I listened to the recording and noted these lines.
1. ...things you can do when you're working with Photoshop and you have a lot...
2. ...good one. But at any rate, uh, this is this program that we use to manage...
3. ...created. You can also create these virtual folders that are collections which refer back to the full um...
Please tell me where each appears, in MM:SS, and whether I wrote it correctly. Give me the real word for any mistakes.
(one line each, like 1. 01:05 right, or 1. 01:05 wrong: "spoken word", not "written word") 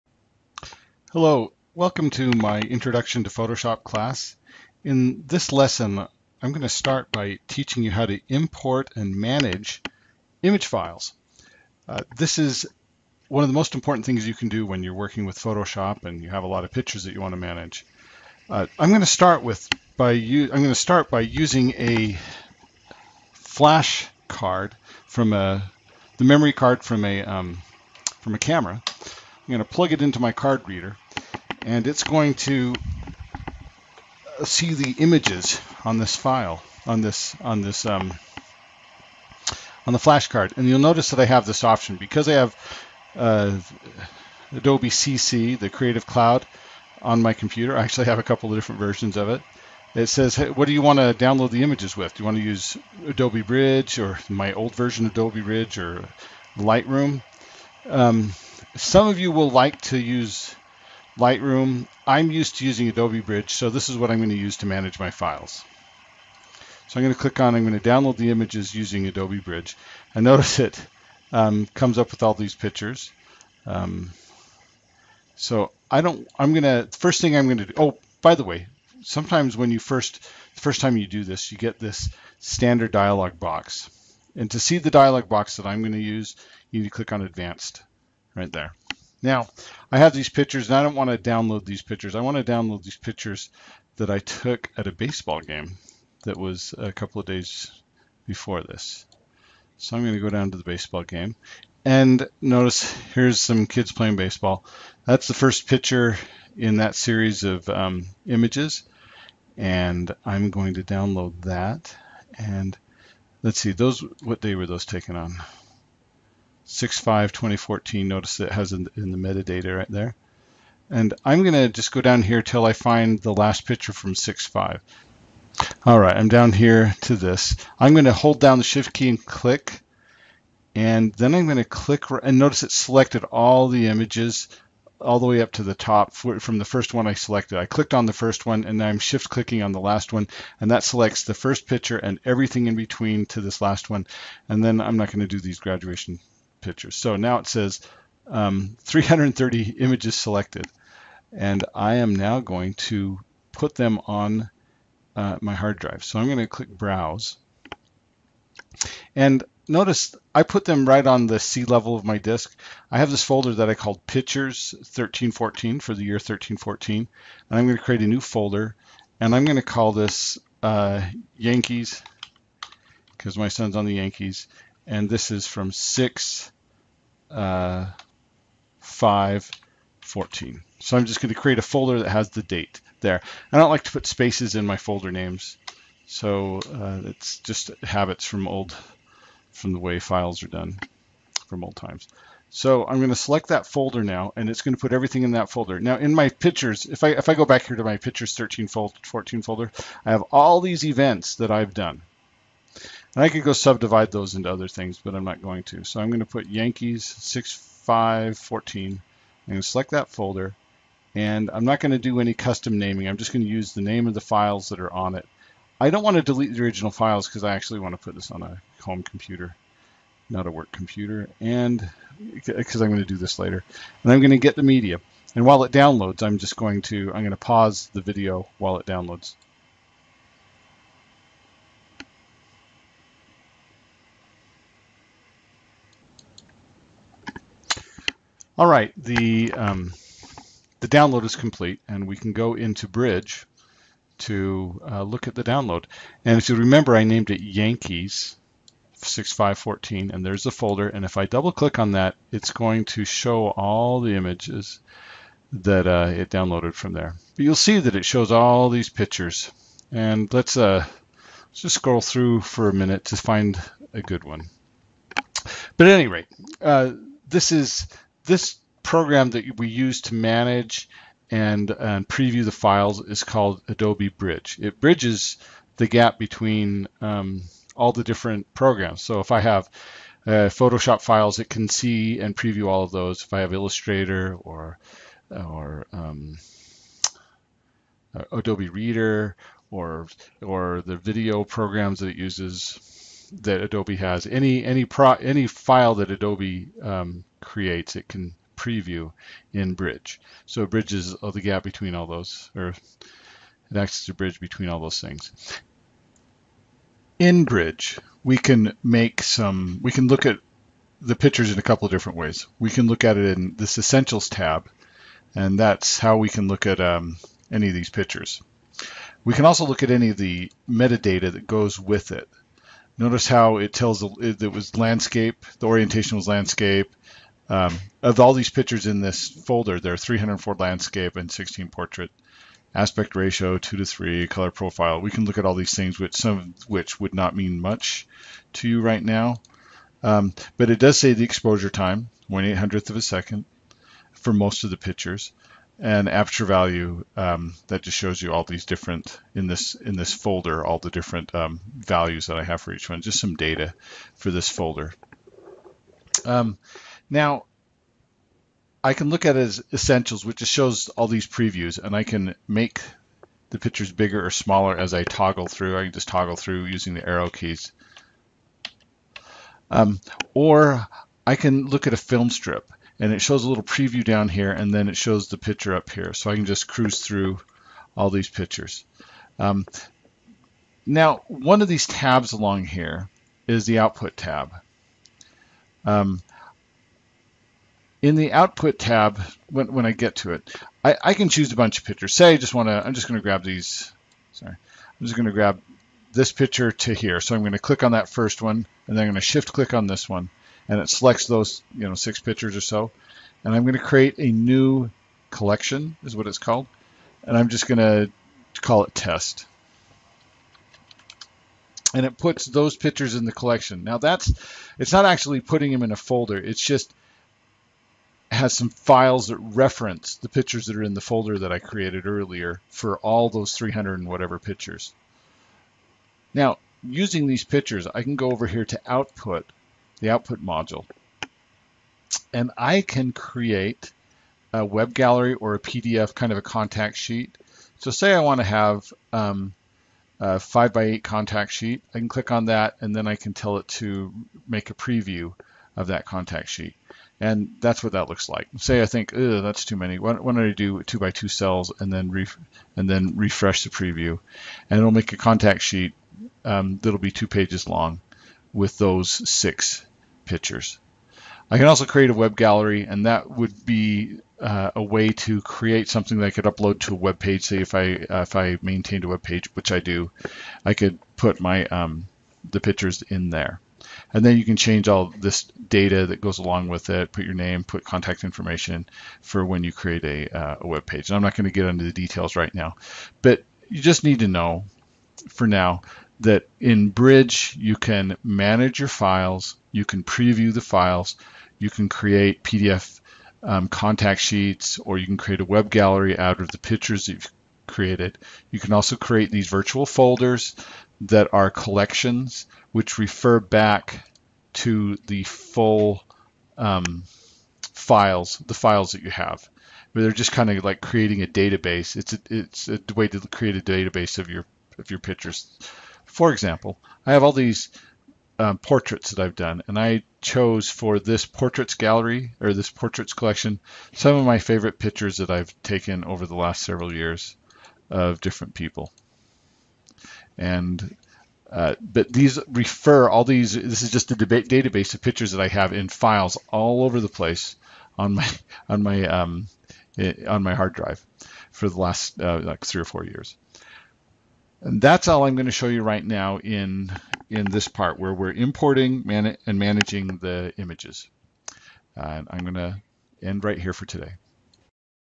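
1. 00:14 right
2. 04:24 right
3. 08:17 right.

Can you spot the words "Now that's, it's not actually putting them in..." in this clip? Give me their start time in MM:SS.
06:53.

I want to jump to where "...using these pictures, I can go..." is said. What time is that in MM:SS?
07:06.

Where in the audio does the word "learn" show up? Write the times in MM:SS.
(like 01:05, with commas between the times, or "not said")
not said.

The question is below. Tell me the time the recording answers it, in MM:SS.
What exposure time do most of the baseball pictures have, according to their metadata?
05:42.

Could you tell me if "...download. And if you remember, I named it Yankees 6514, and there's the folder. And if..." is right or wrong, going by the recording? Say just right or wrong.
right.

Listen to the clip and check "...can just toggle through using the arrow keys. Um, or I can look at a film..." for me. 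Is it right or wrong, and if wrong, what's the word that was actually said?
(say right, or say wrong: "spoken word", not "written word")
right.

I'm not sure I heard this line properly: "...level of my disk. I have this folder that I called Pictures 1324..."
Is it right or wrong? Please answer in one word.
wrong.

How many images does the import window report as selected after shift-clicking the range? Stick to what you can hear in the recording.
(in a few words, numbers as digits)
330.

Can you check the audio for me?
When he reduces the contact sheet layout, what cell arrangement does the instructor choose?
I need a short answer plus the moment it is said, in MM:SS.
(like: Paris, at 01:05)
2 by 2, at 07:30.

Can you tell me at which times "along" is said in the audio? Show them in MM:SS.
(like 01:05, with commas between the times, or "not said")
06:22, 07:56.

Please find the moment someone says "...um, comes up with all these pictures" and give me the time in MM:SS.
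01:11.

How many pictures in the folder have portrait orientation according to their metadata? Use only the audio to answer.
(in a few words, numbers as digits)
16.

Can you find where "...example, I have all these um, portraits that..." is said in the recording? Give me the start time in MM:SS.
08:36.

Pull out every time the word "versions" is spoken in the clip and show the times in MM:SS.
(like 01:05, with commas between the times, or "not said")
00:48, 00:54.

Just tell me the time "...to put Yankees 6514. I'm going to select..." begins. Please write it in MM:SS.
03:26.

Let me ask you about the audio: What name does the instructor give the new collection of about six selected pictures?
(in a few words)
test.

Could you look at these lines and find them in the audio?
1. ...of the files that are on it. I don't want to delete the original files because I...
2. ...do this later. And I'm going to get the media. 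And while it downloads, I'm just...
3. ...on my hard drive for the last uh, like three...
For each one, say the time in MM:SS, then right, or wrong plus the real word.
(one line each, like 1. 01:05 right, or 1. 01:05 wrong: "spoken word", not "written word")
1. 03:34 right
2. 03:43 right
3. 09:00 right.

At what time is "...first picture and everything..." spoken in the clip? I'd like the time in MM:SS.
02:21.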